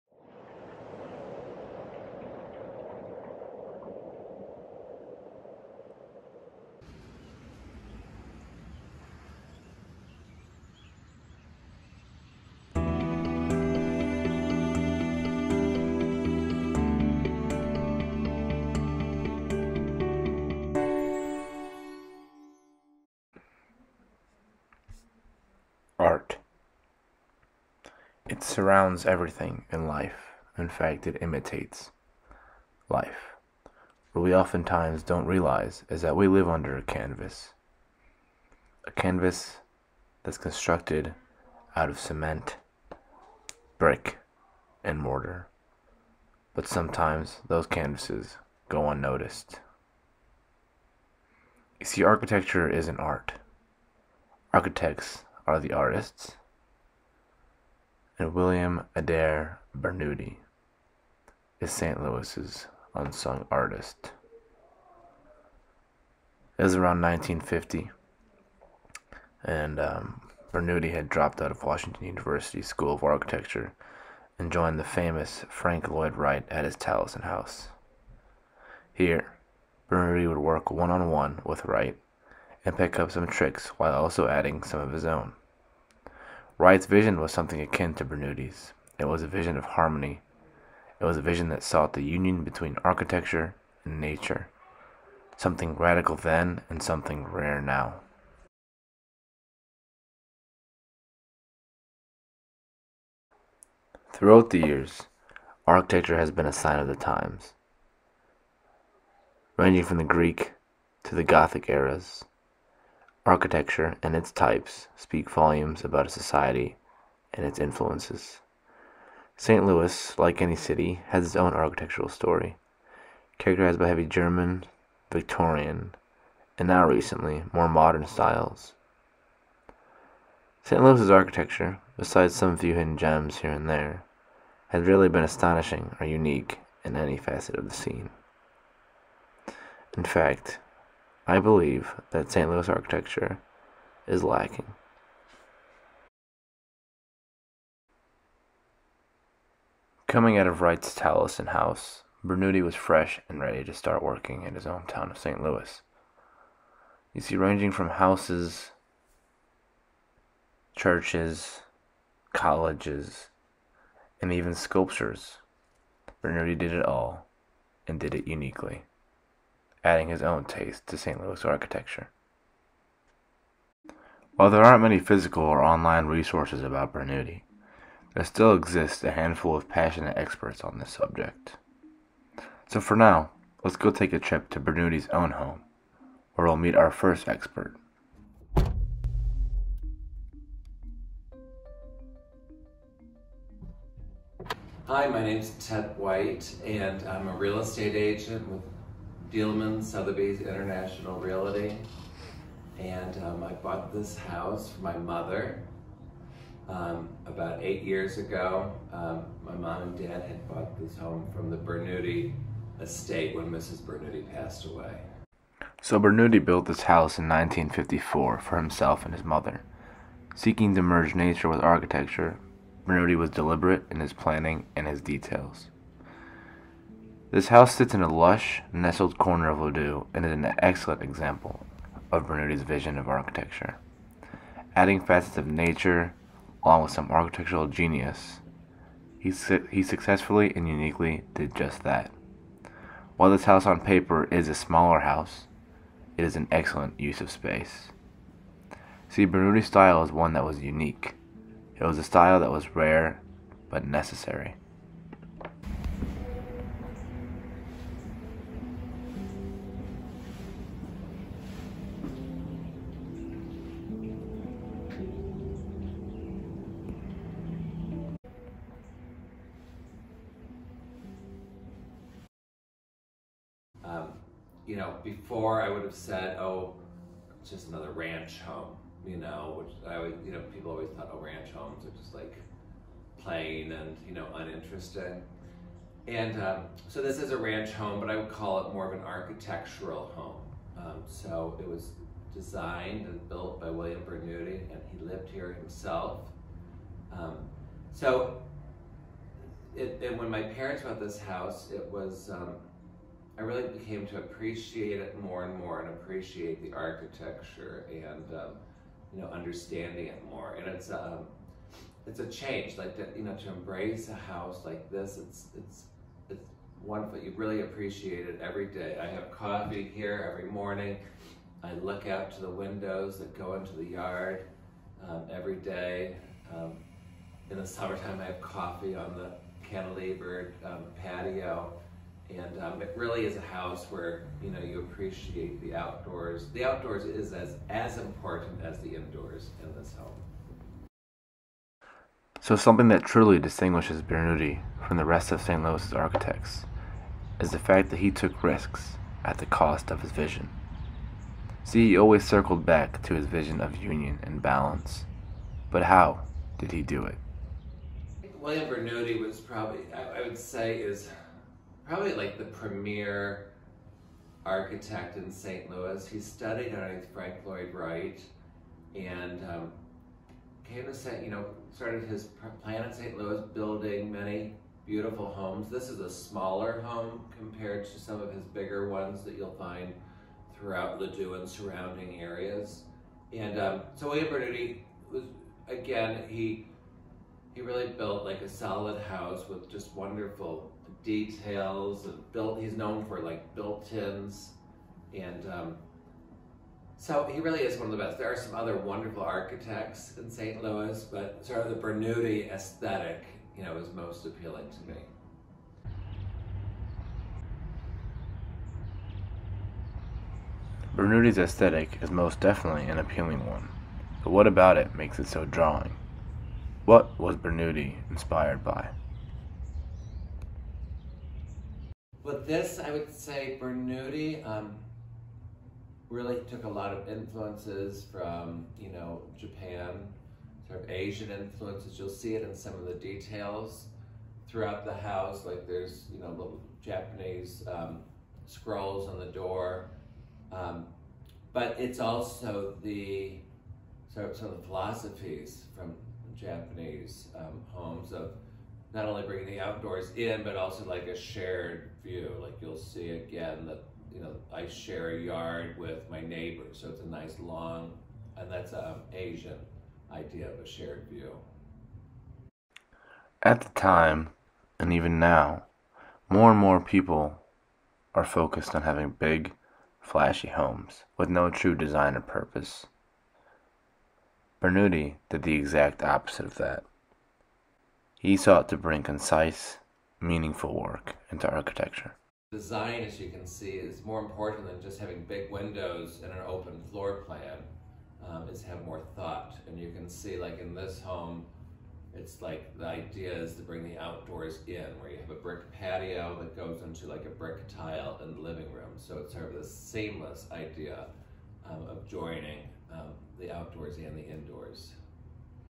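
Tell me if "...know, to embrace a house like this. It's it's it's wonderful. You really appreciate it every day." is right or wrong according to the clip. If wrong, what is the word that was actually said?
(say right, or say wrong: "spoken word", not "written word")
right.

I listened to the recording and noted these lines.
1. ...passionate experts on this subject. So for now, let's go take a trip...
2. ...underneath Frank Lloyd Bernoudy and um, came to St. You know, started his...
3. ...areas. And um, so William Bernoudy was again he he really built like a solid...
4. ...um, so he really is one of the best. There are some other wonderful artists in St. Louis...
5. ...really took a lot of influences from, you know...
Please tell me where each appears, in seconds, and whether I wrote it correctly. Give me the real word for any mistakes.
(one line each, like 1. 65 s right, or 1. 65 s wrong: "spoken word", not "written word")
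1. 179 s right
2. 366 s wrong: "Wright", not "Bernoudy"
3. 382 s right
4. 395 s wrong: "architects", not "artists"
5. 426 s right.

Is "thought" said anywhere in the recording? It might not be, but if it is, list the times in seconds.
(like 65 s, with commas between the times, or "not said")
280 s, 489 s.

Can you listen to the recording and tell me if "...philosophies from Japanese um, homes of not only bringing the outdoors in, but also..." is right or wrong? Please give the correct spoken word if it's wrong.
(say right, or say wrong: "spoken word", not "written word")
right.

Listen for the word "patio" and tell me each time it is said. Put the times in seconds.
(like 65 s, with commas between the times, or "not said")
331 s, 495 s.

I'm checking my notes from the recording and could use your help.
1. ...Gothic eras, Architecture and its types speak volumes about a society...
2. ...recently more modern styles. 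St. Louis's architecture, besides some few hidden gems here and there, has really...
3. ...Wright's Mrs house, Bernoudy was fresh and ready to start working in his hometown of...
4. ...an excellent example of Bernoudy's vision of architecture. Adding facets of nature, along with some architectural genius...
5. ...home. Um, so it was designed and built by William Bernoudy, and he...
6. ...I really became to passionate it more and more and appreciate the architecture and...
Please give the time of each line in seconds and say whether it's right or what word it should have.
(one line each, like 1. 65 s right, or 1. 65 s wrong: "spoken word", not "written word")
1. 111 s right
2. 126 s right
3. 150 s wrong: "Taliesin", not "Mrs"
4. 230 s right
5. 290 s right
6. 303 s wrong: "appreciate", not "passionate".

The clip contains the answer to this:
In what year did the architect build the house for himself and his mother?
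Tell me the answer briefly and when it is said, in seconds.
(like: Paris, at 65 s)
1954, at 217 s.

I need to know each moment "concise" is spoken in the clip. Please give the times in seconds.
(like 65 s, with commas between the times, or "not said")
479 s.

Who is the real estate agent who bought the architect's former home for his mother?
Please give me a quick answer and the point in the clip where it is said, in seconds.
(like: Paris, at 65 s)
Ted White, at 195 s.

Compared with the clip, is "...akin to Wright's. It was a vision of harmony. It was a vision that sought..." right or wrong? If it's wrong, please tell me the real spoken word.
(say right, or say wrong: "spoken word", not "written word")
wrong: "Bernoudy", not "Wright".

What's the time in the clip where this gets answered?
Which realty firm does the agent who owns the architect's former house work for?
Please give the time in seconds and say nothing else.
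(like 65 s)
199 s.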